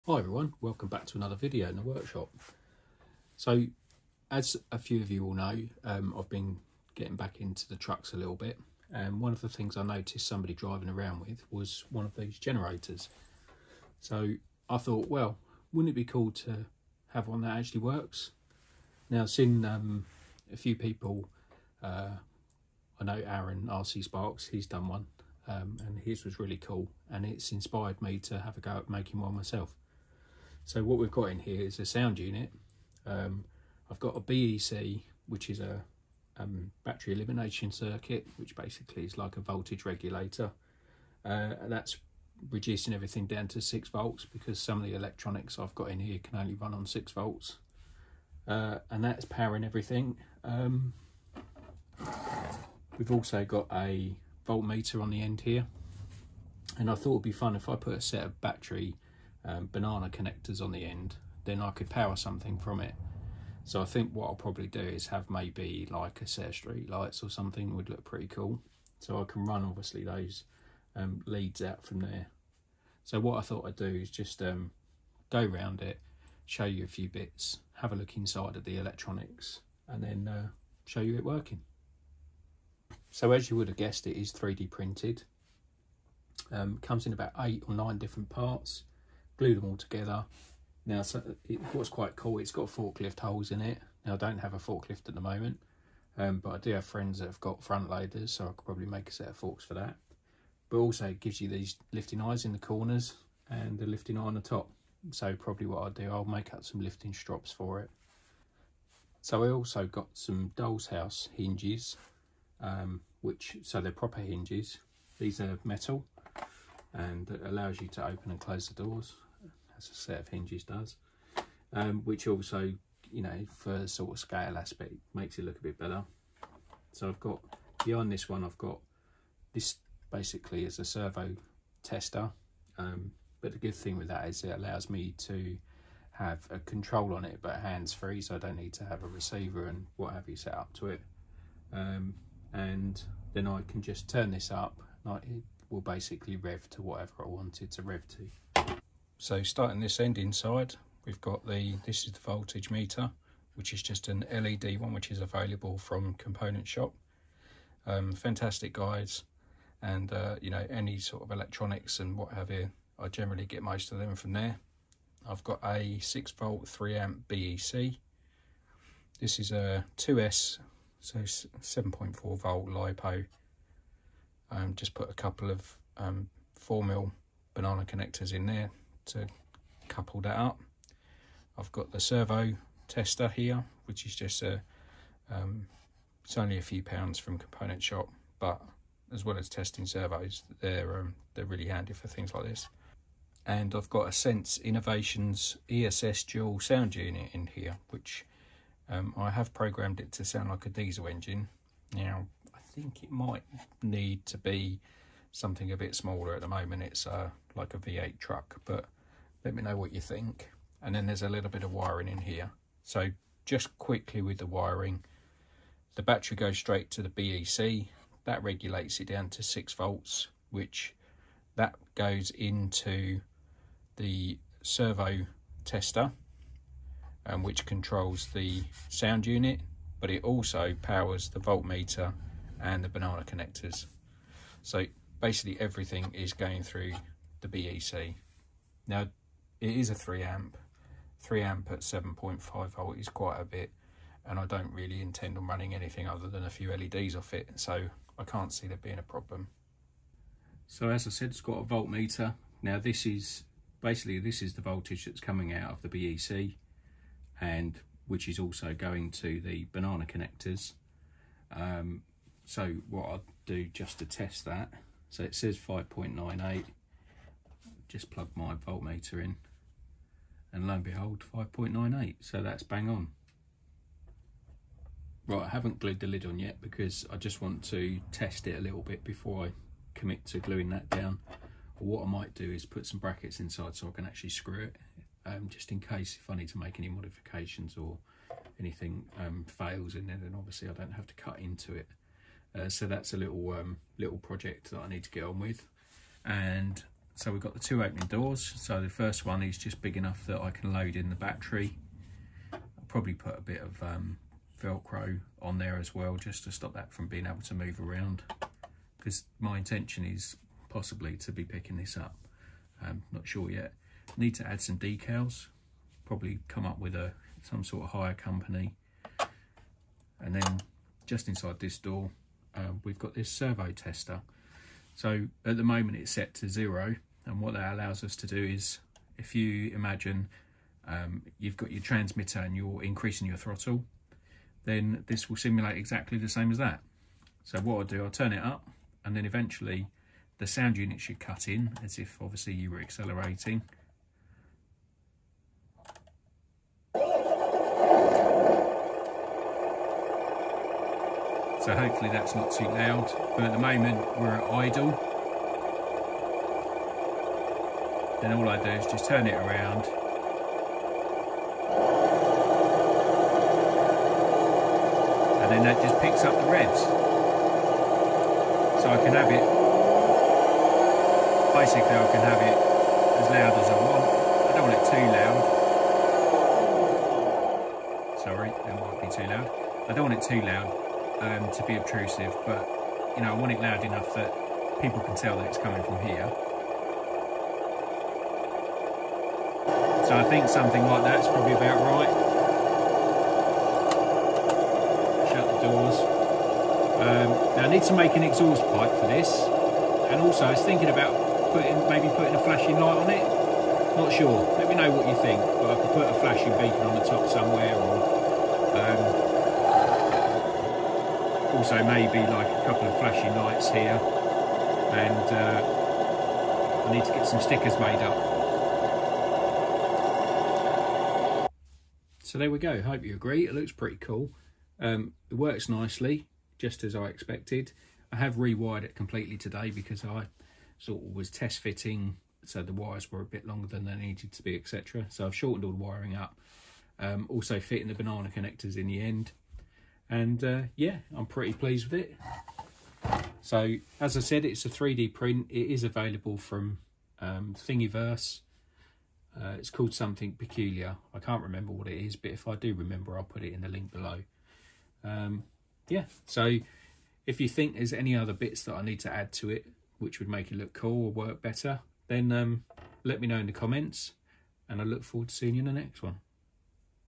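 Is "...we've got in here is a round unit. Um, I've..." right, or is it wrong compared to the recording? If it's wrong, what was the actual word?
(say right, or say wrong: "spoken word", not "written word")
wrong: "sound", not "round".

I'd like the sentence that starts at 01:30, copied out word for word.
Now, so it, what's quite cool, it's got forklift holes in it.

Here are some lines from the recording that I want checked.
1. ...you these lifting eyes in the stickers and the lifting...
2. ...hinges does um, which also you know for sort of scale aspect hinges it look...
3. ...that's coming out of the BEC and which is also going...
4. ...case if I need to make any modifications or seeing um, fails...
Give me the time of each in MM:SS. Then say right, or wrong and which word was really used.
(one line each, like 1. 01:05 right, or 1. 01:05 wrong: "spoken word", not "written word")
1. 01:41 wrong: "corners", not "stickers"
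2. 02:00 wrong: "makes", not "hinges"
3. 04:15 right
4. 04:45 wrong: "anything", not "seeing".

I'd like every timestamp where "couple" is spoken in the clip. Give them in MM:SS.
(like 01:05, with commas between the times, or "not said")
02:55, 02:59, 06:52.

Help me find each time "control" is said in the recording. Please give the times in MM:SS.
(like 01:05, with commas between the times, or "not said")
02:16, 03:47.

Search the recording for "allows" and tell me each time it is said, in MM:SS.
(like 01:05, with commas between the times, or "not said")
01:57, 02:14, 05:27.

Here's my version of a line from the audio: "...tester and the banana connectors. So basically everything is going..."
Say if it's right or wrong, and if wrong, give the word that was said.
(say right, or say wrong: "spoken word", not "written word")
wrong: "voltmeter", not "tester".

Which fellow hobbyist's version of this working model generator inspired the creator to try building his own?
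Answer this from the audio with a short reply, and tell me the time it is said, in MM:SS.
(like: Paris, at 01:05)
Aaron RC Sparks, at 00:23.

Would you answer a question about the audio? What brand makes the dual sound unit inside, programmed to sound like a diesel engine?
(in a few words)
Sense Innovations.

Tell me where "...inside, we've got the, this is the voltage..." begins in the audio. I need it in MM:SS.
02:30.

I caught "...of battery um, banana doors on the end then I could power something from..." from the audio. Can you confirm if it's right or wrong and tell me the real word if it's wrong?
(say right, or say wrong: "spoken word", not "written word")
wrong: "connectors", not "doors".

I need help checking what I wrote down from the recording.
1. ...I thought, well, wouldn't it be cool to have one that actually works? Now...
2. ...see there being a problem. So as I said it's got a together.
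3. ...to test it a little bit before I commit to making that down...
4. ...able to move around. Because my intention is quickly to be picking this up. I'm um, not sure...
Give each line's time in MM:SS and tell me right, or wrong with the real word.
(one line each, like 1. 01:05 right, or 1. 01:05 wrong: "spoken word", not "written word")
1. 00:14 right
2. 04:08 wrong: "voltmeter", not "together"
3. 04:37 wrong: "gluing", not "making"
4. 05:07 wrong: "possibly", not "quickly".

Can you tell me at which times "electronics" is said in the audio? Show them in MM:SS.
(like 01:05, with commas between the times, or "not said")
00:44, 01:18, 02:41.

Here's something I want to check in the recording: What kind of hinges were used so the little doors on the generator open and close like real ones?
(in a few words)
doll's house hinges.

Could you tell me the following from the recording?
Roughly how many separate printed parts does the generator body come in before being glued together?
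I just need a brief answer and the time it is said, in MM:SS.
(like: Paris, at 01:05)
8 or 9, at 01:27.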